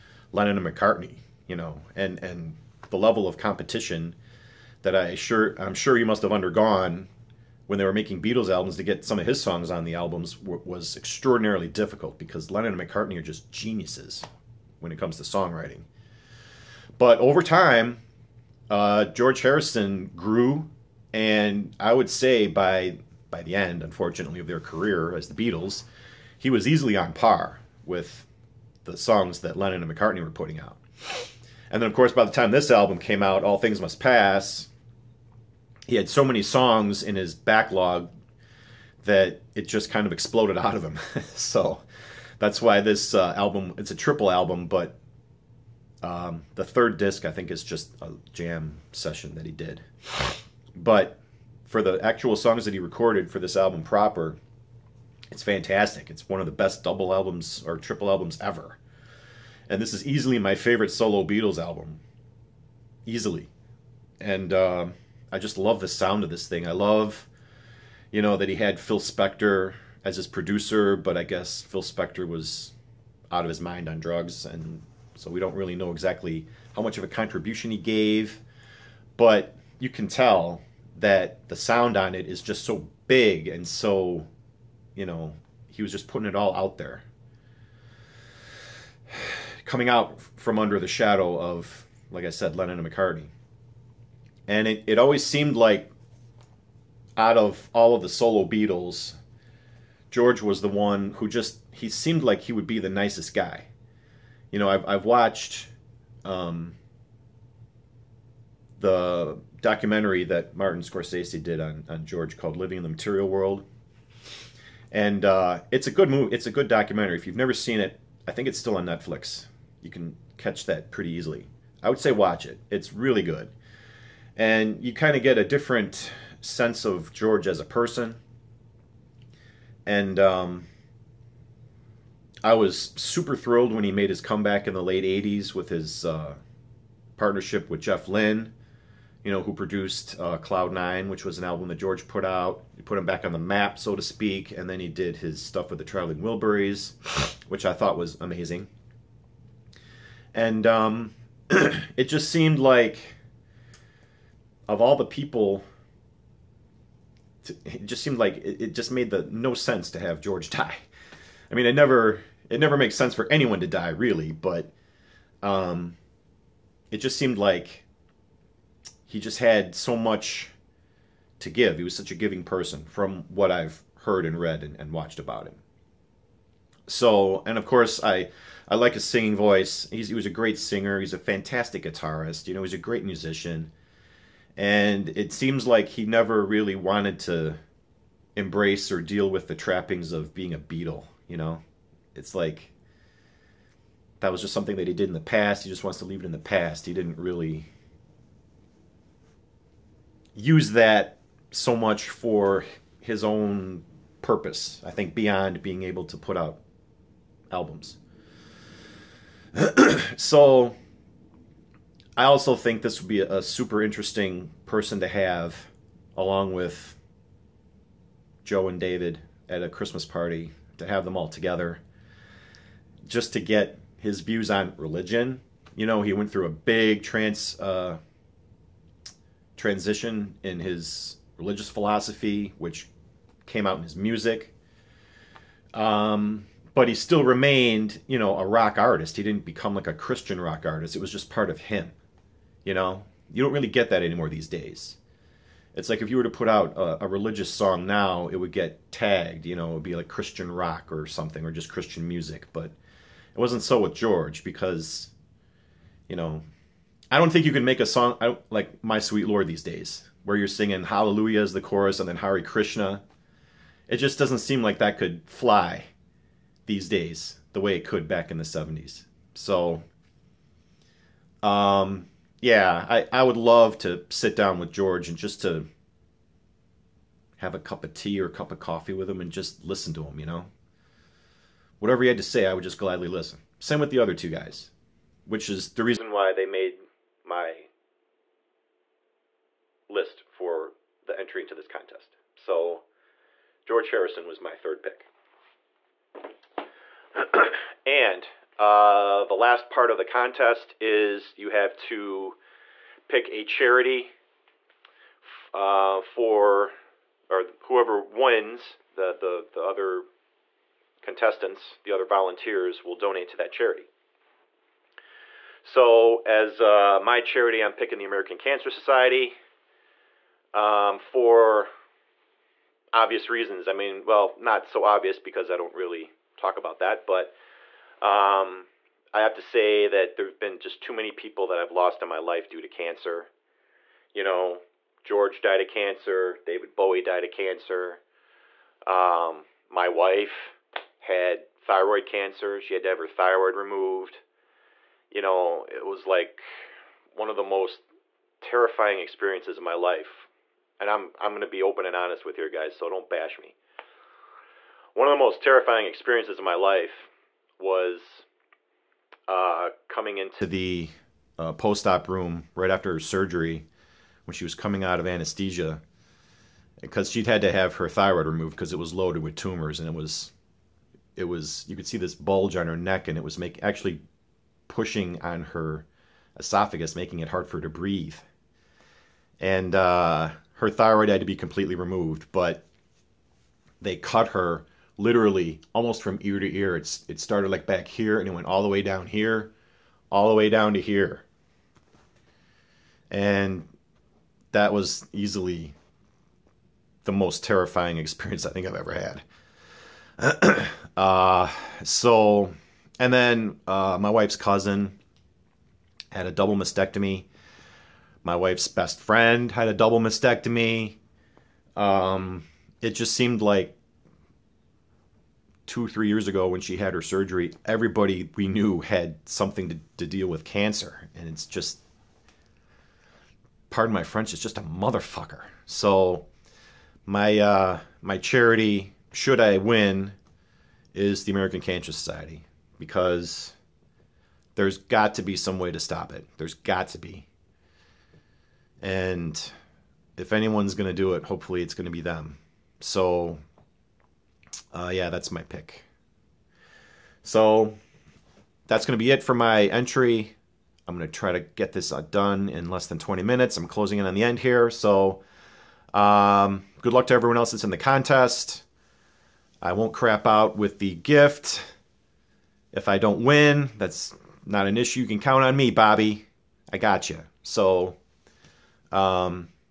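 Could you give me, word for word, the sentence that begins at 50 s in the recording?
But for the actual songs that he recorded for this album proper, it's fantastic.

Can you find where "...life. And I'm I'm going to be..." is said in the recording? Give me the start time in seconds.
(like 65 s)
349 s.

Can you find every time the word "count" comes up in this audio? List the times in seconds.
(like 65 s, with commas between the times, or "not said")
465 s.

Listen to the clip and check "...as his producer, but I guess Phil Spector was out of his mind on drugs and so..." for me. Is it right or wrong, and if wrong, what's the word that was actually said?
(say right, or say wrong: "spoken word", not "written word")
right.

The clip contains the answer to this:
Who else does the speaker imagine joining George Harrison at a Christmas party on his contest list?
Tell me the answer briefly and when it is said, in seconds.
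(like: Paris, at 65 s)
Joe and David, at 218 s.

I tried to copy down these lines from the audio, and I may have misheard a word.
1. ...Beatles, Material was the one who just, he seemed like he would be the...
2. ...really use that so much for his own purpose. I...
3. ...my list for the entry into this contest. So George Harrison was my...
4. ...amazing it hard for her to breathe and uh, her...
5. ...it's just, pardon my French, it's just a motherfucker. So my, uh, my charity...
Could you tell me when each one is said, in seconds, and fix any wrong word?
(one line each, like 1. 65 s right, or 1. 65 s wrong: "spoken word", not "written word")
1. 98 s wrong: "George", not "Material"
2. 197 s right
3. 287 s right
4. 376 s wrong: "making", not "amazing"
5. 421 s right.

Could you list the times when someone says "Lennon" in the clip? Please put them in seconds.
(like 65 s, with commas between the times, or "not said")
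0 s, 12 s, 29 s, 92 s.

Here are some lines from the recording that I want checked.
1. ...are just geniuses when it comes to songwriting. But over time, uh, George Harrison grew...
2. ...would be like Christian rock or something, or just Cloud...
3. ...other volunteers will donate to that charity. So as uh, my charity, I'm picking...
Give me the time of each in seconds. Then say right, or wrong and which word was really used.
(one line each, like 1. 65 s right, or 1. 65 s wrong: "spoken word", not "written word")
1. 13 s right
2. 249 s wrong: "Christian", not "Cloud"
3. 311 s right.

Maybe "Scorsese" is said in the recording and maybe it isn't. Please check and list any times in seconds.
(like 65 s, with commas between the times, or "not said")
110 s.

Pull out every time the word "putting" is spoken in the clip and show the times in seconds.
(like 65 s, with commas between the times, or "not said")
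30 s, 86 s.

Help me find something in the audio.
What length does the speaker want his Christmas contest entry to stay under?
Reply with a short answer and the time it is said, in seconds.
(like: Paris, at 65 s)
20 minutes, at 452 s.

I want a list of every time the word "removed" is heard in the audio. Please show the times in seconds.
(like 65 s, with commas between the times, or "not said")
343 s, 368 s, 381 s.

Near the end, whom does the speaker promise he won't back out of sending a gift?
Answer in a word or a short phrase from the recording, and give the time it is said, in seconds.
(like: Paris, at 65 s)
Bobby, at 465 s.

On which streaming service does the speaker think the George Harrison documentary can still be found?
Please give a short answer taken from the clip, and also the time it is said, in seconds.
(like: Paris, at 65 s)
Netflix, at 118 s.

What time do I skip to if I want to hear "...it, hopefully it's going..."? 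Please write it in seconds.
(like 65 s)
441 s.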